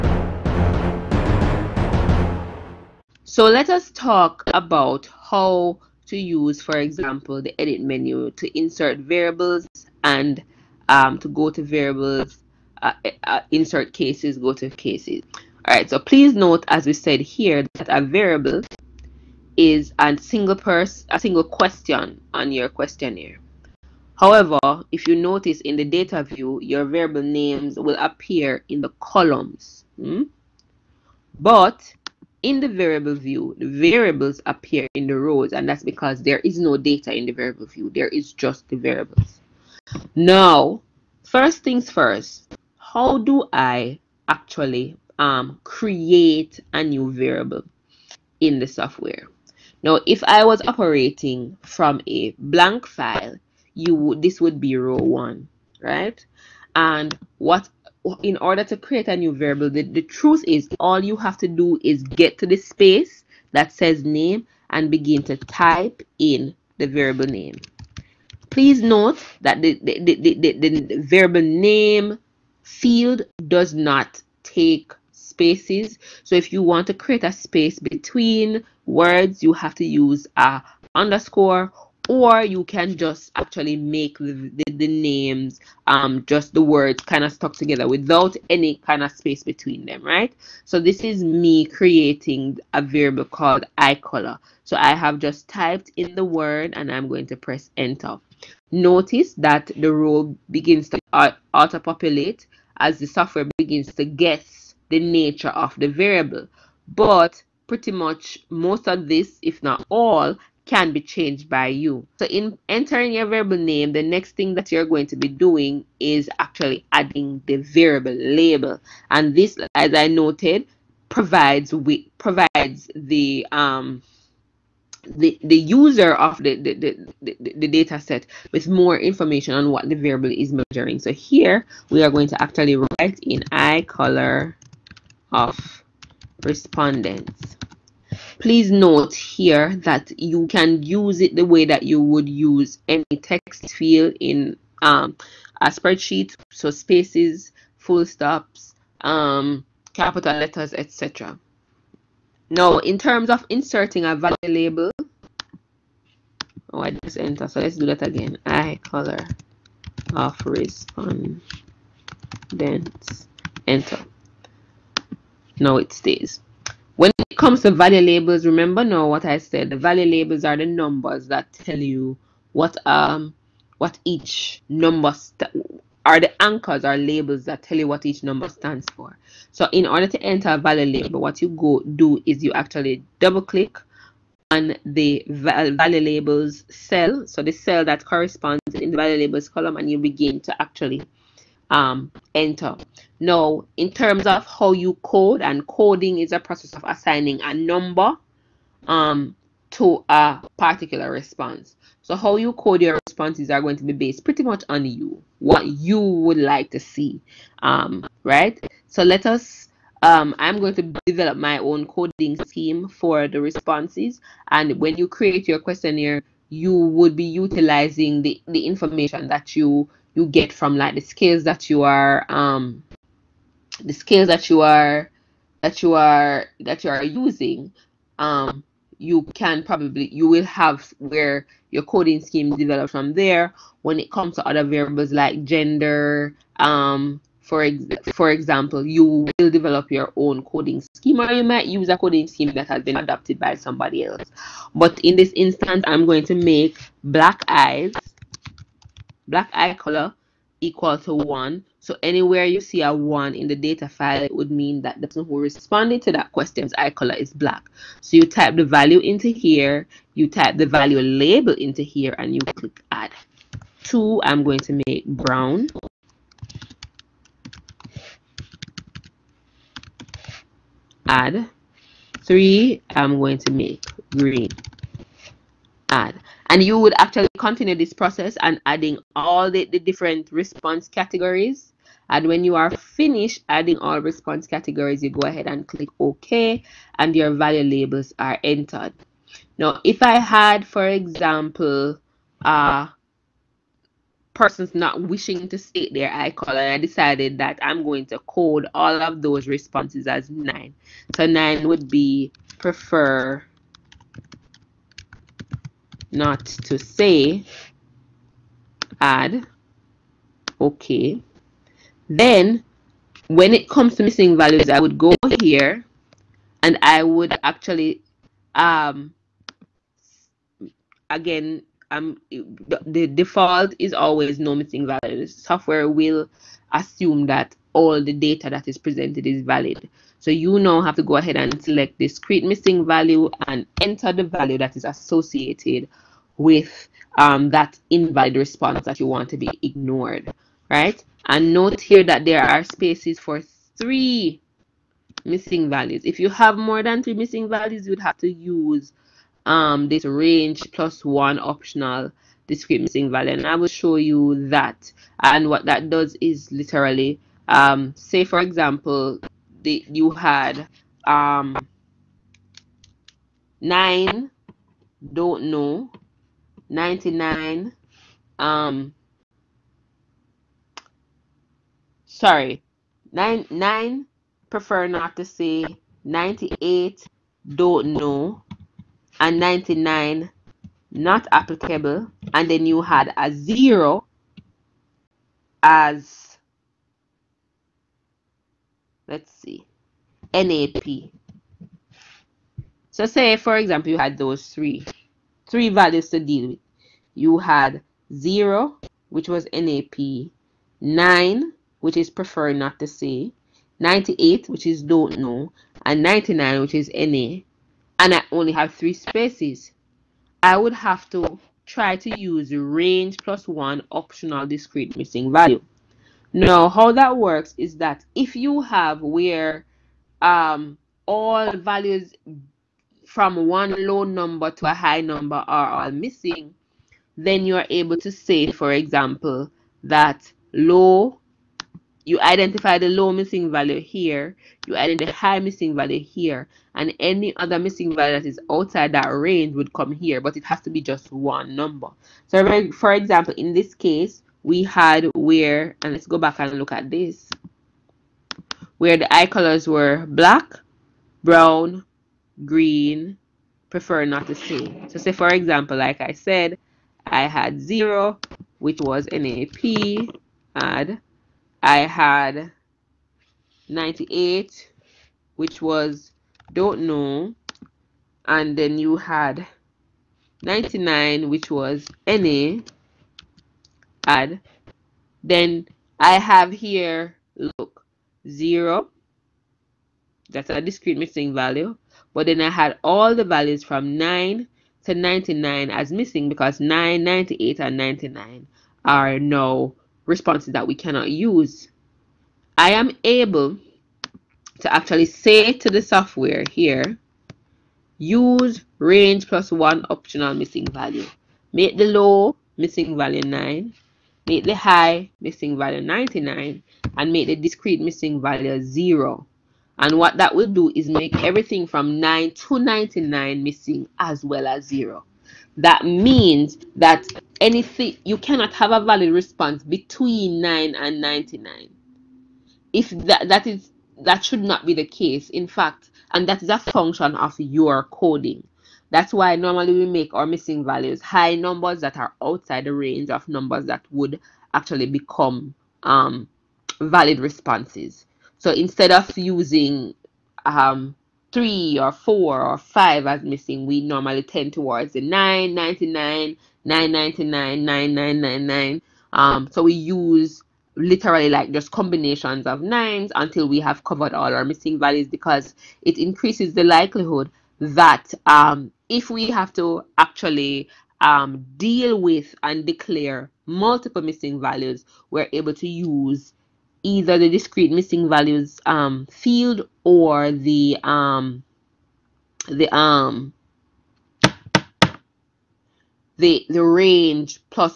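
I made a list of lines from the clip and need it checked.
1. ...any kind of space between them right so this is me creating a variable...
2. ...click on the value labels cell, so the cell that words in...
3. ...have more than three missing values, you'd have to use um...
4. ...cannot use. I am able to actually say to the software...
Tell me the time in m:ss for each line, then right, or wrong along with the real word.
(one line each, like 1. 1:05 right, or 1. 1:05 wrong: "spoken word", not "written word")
1. 1:28 right
2. 3:03 wrong: "corresponds", not "words"
3. 5:46 right
4. 8:10 right.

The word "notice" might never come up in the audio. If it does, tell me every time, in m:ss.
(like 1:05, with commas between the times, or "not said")
0:25, 1:38.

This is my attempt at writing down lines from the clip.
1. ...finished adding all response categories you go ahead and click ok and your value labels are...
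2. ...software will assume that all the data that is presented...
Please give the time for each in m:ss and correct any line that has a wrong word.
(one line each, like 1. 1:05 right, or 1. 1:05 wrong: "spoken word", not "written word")
1. 4:42 right
2. 5:25 right.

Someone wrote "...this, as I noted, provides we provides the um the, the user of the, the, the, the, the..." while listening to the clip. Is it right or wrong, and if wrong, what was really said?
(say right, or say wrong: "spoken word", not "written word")
right.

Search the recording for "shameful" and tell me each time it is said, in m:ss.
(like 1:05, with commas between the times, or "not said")
not said.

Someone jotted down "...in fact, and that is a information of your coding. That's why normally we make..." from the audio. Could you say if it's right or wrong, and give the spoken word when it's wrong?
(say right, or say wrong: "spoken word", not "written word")
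wrong: "function", not "information".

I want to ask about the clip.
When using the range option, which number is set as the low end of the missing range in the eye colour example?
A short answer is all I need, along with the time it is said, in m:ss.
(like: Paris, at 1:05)
9, at 8:21.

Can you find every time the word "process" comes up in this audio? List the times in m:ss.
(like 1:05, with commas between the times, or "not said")
3:16, 4:37.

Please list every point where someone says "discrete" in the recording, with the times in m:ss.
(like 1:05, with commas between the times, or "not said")
5:31, 5:52, 6:54, 8:00, 8:27, 9:27.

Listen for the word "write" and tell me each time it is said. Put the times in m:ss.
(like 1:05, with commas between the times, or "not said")
2:12.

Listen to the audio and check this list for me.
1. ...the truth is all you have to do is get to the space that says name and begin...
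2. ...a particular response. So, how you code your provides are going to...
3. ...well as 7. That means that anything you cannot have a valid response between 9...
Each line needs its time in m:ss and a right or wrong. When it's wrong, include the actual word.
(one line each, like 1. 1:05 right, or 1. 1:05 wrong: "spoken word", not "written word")
1. 0:59 right
2. 3:20 wrong: "responses", not "provides"
3. 8:34 wrong: "0", not "7".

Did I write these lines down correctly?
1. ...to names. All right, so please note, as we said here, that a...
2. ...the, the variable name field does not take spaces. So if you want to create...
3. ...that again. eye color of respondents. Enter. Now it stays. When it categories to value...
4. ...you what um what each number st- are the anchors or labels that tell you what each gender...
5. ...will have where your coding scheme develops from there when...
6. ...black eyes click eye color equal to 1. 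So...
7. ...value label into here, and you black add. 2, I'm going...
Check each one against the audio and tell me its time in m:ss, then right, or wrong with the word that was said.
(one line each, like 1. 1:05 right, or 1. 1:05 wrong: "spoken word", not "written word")
1. 0:14 wrong: "cases", not "names"
2. 1:10 right
3. 2:37 wrong: "comes", not "categories"
4. 2:51 wrong: "number", not "gender"
5. 3:50 right
6. 4:07 wrong: "black", not "click"
7. 4:20 wrong: "click", not "black".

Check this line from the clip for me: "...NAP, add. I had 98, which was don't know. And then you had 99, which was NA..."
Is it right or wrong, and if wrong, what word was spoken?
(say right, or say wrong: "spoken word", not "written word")
right.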